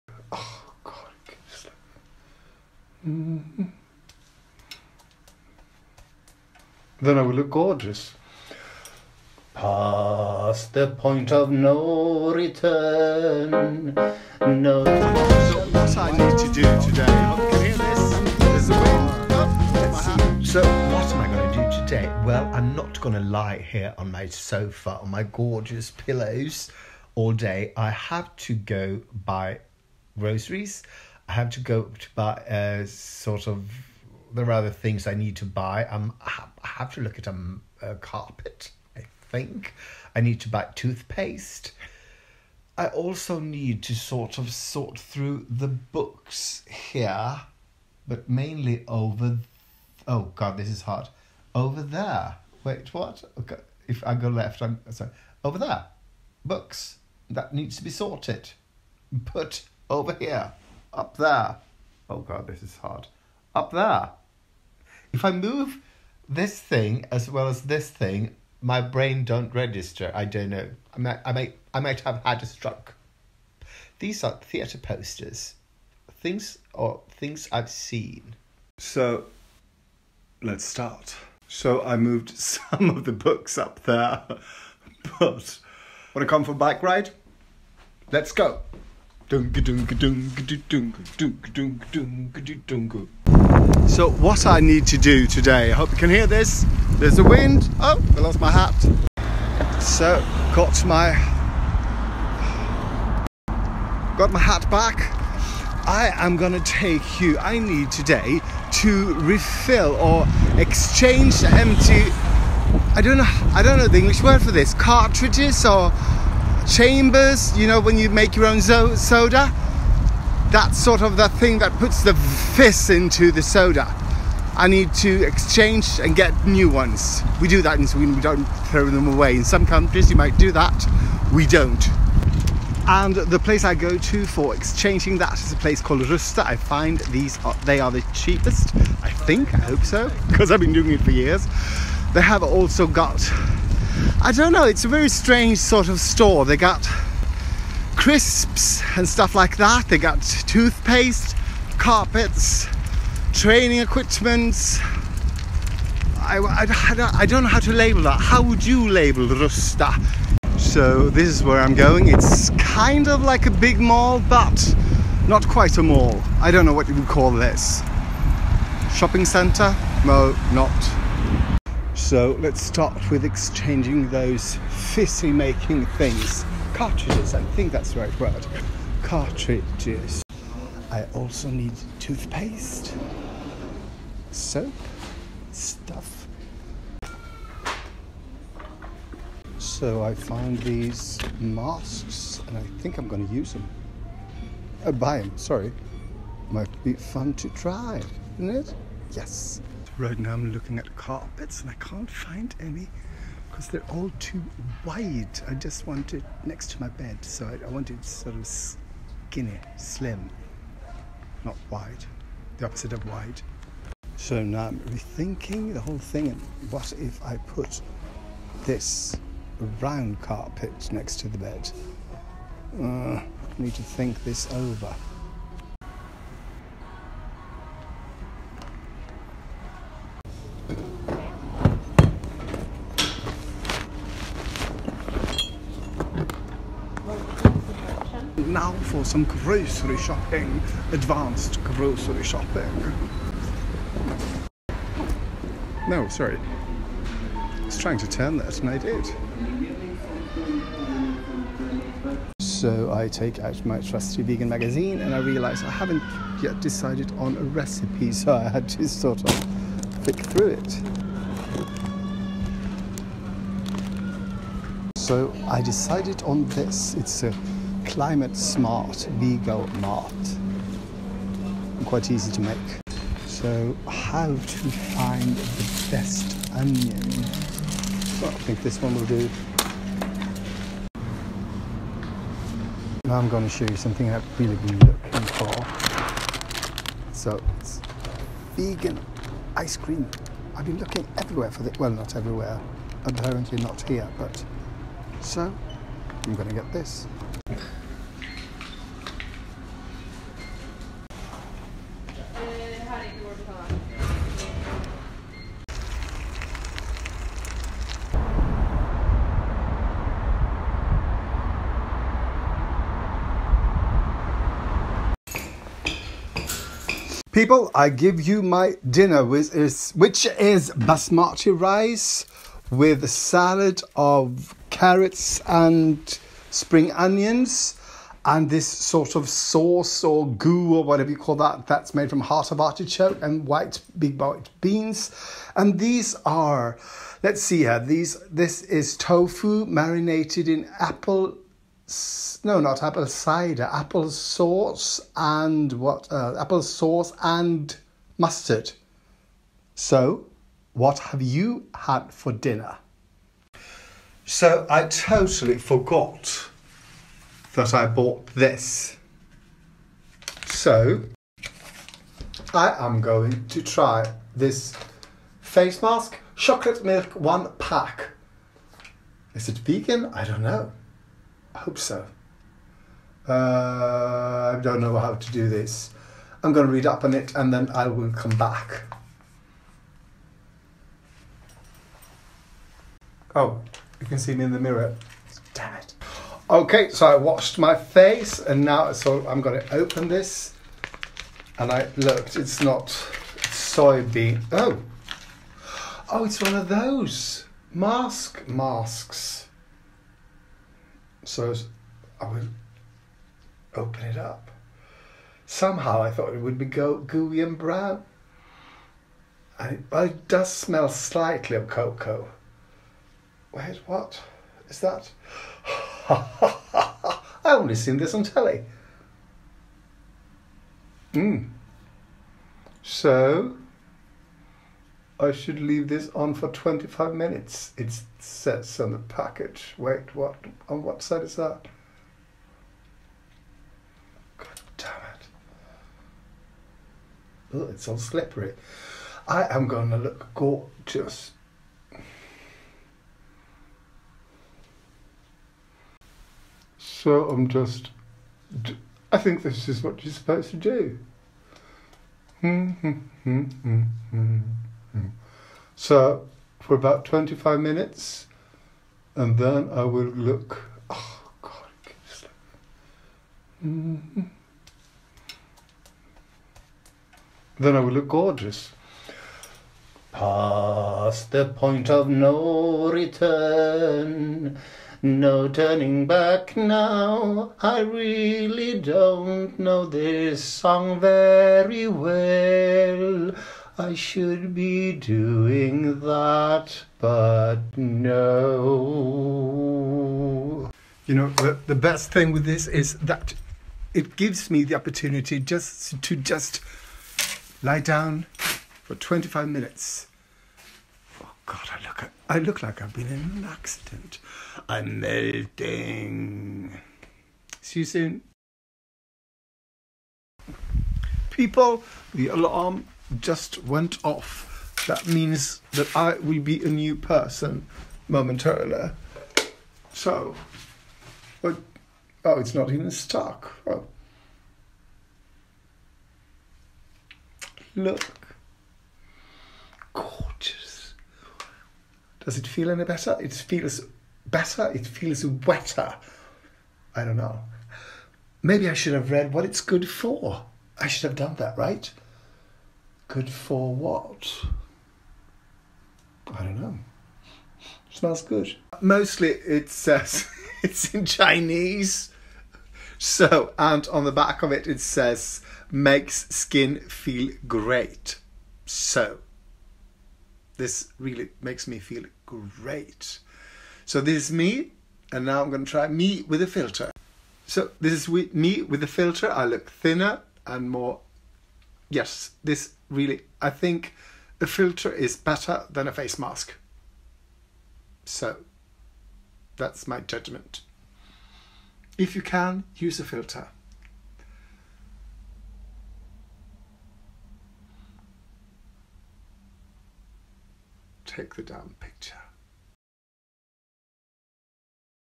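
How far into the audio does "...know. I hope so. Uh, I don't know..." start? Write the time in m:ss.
6:10.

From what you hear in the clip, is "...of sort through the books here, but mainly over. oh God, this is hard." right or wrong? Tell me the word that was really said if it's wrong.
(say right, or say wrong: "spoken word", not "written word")
right.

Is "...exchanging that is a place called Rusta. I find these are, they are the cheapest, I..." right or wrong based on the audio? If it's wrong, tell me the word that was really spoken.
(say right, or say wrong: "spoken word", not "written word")
right.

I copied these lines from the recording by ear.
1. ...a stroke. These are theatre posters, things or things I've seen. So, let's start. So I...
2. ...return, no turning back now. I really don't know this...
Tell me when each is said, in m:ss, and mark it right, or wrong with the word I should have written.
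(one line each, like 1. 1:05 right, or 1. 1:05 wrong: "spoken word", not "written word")
1. 1:12 right
2. 7:52 right.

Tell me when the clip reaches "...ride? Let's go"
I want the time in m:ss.
1:26.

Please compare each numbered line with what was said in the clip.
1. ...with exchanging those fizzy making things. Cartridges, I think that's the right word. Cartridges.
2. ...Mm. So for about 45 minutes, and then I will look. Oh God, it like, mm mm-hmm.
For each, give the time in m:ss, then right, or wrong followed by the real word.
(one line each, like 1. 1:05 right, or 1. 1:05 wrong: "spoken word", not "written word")
1. 2:53 right
2. 7:34 wrong: "25", not "45".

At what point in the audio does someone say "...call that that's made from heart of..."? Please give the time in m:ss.
5:31.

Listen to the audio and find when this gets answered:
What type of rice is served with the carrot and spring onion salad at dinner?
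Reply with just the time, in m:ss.
5:20.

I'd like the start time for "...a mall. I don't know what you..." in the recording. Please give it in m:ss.
2:45.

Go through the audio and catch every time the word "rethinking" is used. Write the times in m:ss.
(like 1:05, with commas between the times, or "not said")
3:34.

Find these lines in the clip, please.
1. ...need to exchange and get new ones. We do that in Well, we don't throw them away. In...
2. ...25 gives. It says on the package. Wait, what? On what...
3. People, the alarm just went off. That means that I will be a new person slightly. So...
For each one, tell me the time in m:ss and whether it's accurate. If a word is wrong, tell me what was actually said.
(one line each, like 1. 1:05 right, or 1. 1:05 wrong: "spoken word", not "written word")
1. 2:04 wrong: "Sweden", not "Well"
2. 7:06 wrong: "minutes", not "gives"
3. 8:31 wrong: "momentarily", not "slightly".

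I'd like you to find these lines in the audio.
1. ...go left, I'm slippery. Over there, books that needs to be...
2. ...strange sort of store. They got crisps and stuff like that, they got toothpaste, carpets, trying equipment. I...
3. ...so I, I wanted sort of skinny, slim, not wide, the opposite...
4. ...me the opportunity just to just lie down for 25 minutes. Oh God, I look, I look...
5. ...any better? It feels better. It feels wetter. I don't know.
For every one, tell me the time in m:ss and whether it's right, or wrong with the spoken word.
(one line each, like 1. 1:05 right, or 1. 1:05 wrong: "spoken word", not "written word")
1. 0:54 wrong: "sorry", not "slippery"
2. 2:25 wrong: "training", not "trying"
3. 3:27 right
4. 8:14 right
5. 8:52 right.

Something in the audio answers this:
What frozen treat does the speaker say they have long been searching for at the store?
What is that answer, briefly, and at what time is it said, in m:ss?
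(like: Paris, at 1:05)
Vegan ice cream, at 4:48.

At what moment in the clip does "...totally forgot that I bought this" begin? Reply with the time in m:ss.
5:54.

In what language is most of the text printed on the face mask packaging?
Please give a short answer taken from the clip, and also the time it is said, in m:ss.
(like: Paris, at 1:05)
Chinese, at 9:11.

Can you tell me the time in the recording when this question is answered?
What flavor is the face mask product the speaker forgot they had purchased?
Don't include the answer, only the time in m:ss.
6:06.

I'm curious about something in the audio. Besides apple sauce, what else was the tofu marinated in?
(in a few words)
Mustard.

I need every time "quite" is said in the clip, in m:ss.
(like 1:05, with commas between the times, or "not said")
2:45, 4:31.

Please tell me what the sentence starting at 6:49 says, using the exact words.
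And it, well, it does smell slightly of cocoa.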